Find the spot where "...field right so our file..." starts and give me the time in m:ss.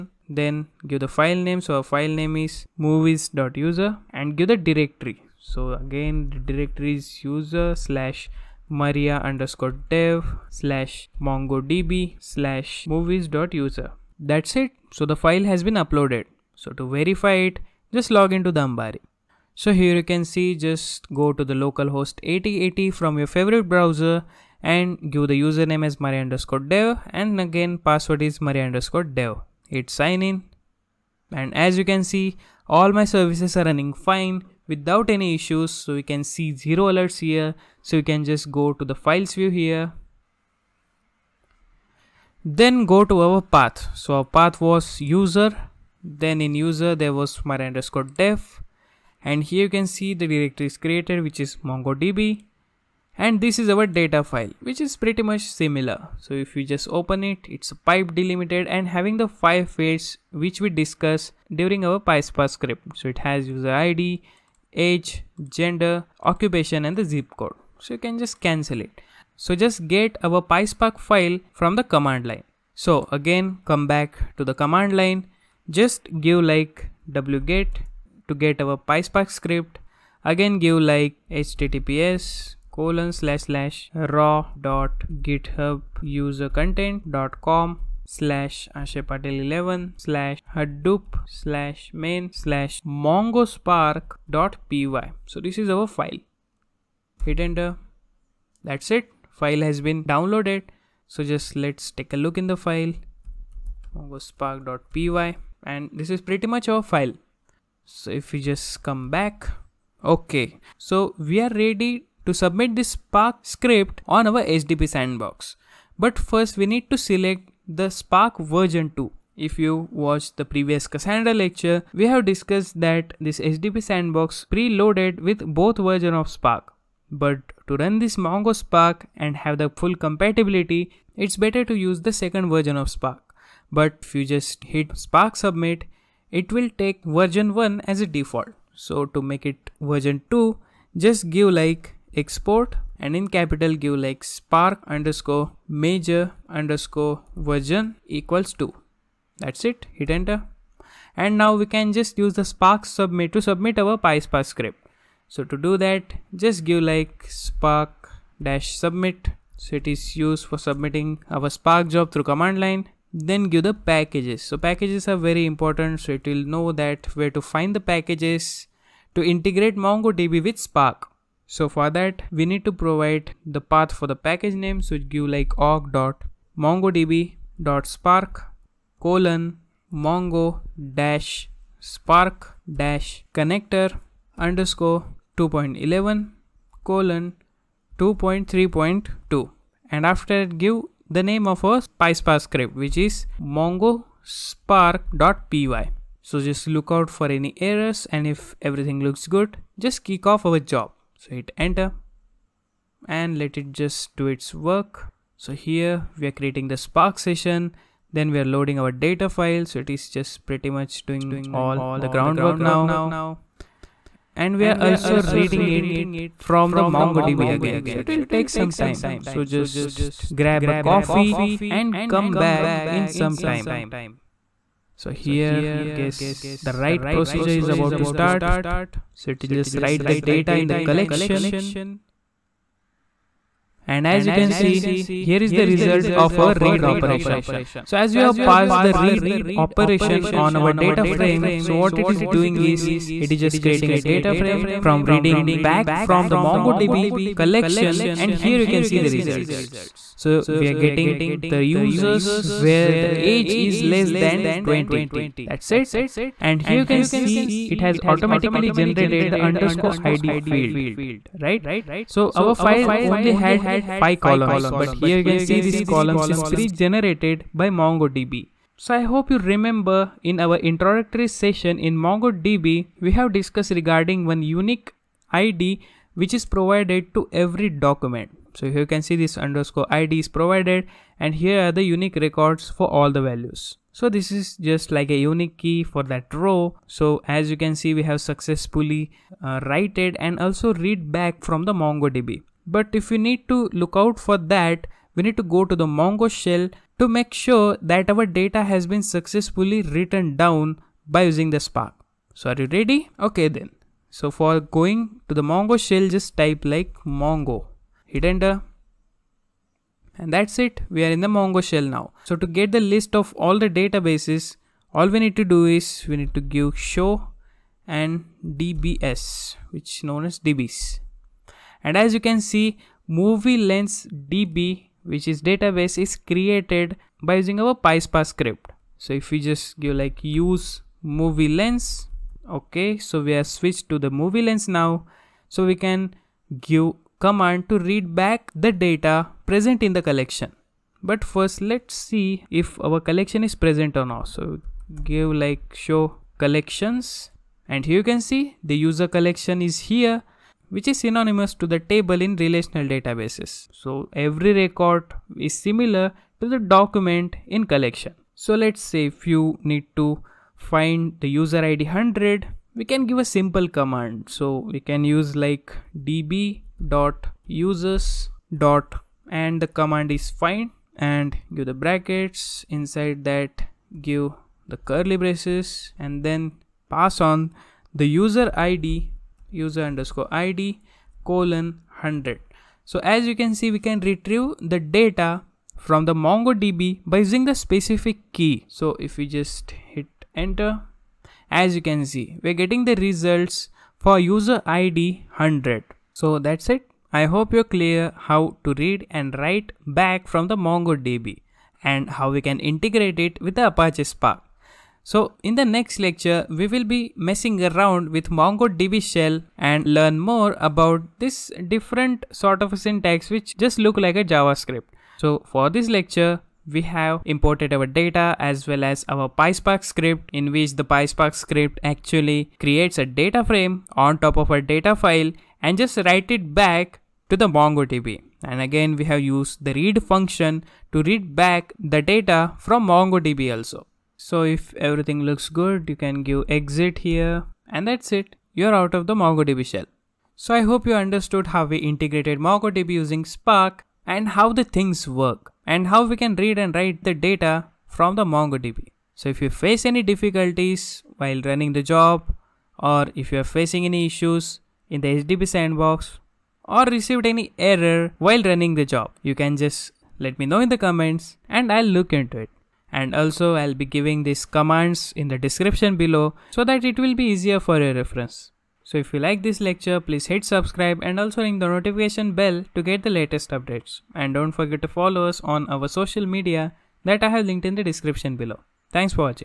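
4:20.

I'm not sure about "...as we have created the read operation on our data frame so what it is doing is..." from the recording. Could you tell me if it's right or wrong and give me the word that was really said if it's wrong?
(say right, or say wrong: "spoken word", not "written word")
wrong: "passed", not "created".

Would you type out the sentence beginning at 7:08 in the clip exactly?
And again, we have used the read function to read back the data from MongoDB also.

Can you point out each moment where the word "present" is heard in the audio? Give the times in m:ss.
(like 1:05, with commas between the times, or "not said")
5:39, 5:43.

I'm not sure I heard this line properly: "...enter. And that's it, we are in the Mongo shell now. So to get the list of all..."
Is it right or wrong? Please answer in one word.
right.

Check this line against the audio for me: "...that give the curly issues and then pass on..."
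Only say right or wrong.
wrong.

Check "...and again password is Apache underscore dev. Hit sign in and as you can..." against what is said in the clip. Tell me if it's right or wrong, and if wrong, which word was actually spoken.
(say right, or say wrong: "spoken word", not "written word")
wrong: "Maria", not "Apache".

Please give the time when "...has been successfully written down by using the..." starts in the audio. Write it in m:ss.
4:58.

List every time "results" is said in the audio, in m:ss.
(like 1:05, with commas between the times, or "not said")
3:55, 4:09, 6:33.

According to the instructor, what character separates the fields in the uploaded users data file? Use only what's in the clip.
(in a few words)
pipe.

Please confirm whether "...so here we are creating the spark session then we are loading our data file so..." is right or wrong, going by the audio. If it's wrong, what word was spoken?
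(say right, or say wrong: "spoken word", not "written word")
right.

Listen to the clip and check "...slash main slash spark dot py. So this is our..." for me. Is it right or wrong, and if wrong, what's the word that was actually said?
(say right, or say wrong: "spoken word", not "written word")
wrong: "mongospark", not "spark".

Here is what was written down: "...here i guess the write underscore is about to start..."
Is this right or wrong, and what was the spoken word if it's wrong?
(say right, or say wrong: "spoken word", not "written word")
wrong: "procedure", not "underscore".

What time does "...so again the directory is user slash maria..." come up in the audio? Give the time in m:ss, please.
0:05.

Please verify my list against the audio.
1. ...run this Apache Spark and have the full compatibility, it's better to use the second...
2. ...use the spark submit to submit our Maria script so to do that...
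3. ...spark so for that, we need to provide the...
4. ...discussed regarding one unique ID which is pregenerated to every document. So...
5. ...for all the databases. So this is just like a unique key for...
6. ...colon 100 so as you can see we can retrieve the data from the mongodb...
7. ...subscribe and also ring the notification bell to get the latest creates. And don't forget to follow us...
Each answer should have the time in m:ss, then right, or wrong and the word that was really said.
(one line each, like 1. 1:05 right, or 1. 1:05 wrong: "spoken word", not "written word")
1. 2:07 wrong: "Mongo", not "Apache"
2. 2:32 wrong: "PySpark", not "Maria"
3. 2:50 right
4. 4:33 wrong: "provided", not "pregenerated"
5. 4:42 wrong: "values", not "databases"
6. 6:21 right
7. 7:50 wrong: "updates", not "creates".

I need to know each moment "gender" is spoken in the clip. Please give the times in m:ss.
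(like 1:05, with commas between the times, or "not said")
1:05.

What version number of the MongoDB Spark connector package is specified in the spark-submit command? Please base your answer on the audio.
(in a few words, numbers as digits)
2.3.2.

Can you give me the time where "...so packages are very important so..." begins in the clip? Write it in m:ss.
2:44.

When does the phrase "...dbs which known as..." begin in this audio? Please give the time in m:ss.
5:18.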